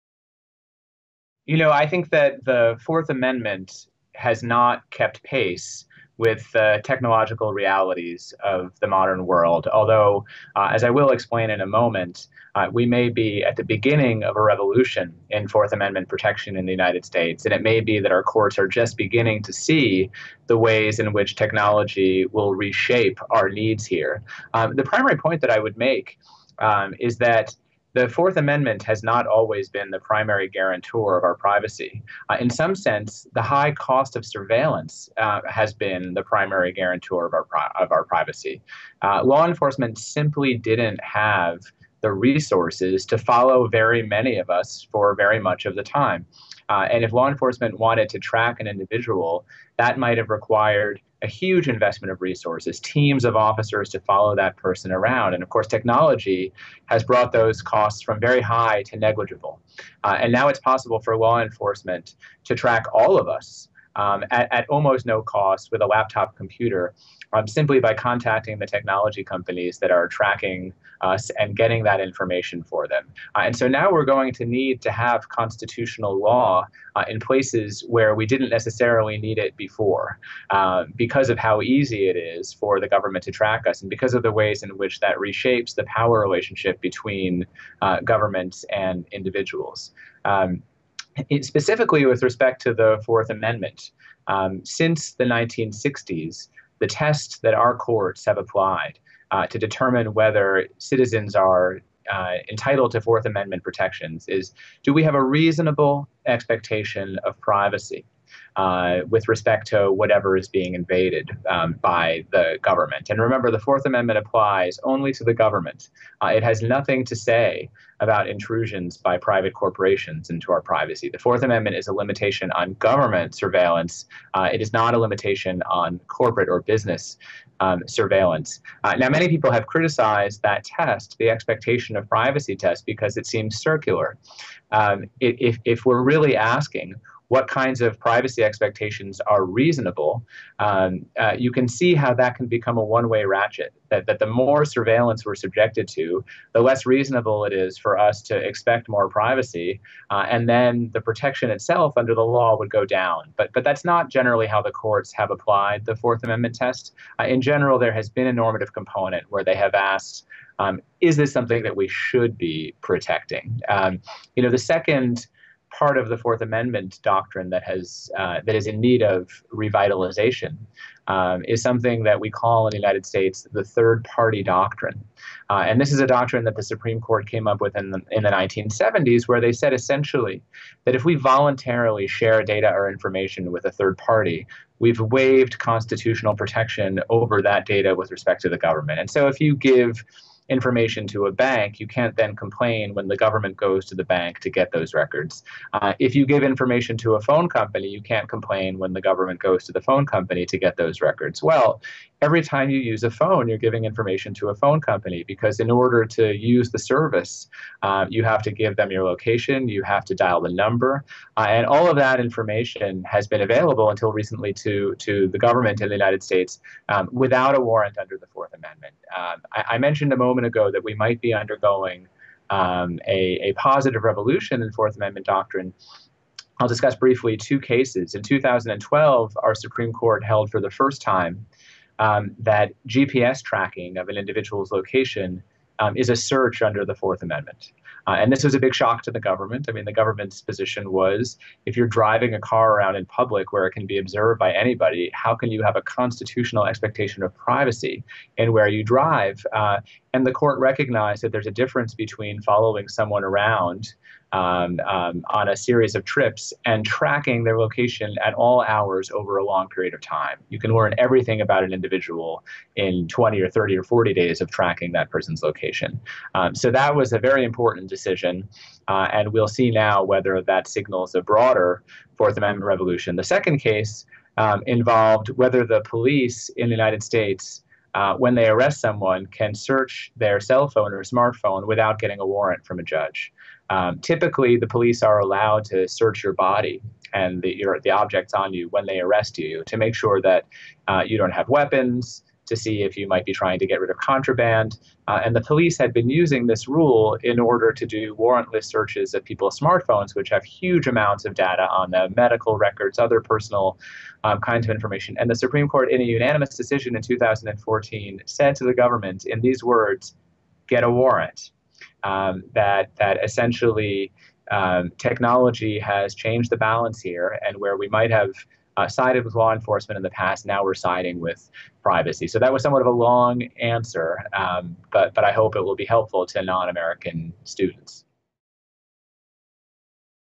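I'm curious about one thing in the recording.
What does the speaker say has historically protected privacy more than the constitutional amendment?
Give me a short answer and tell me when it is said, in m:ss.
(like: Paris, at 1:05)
the high cost of surveillance, at 0:33.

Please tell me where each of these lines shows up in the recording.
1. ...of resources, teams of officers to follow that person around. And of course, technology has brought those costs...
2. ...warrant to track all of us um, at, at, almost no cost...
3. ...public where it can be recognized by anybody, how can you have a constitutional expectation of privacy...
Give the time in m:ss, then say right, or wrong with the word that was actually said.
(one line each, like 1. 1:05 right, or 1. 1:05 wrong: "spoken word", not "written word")
1. 0:52 right
2. 1:01 wrong: "enforcement", not "warrant"
3. 4:03 wrong: "observed", not "recognized".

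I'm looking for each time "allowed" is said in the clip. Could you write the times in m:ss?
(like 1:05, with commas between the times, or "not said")
4:45.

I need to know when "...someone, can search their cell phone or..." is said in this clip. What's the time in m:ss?
4:38.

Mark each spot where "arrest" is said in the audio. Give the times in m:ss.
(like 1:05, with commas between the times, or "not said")
4:38, 4:48.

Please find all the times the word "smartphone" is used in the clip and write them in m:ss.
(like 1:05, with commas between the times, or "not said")
4:41, 4:59.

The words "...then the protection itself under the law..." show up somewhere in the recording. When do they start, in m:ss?
2:30.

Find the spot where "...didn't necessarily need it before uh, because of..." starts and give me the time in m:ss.
1:18.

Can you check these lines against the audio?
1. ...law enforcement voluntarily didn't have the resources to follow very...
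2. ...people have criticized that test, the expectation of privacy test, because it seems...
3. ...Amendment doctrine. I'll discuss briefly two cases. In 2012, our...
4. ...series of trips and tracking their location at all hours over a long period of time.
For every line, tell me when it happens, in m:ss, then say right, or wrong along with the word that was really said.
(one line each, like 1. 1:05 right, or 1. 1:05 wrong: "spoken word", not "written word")
1. 0:39 wrong: "simply", not "voluntarily"
2. 2:09 right
3. 3:44 right
4. 4:15 right.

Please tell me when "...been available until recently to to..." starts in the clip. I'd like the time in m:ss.
3:33.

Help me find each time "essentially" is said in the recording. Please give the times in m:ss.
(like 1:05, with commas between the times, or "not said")
2:59, 5:13.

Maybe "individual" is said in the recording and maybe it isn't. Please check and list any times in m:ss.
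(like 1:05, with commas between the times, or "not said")
0:48, 1:29, 3:54, 4:21.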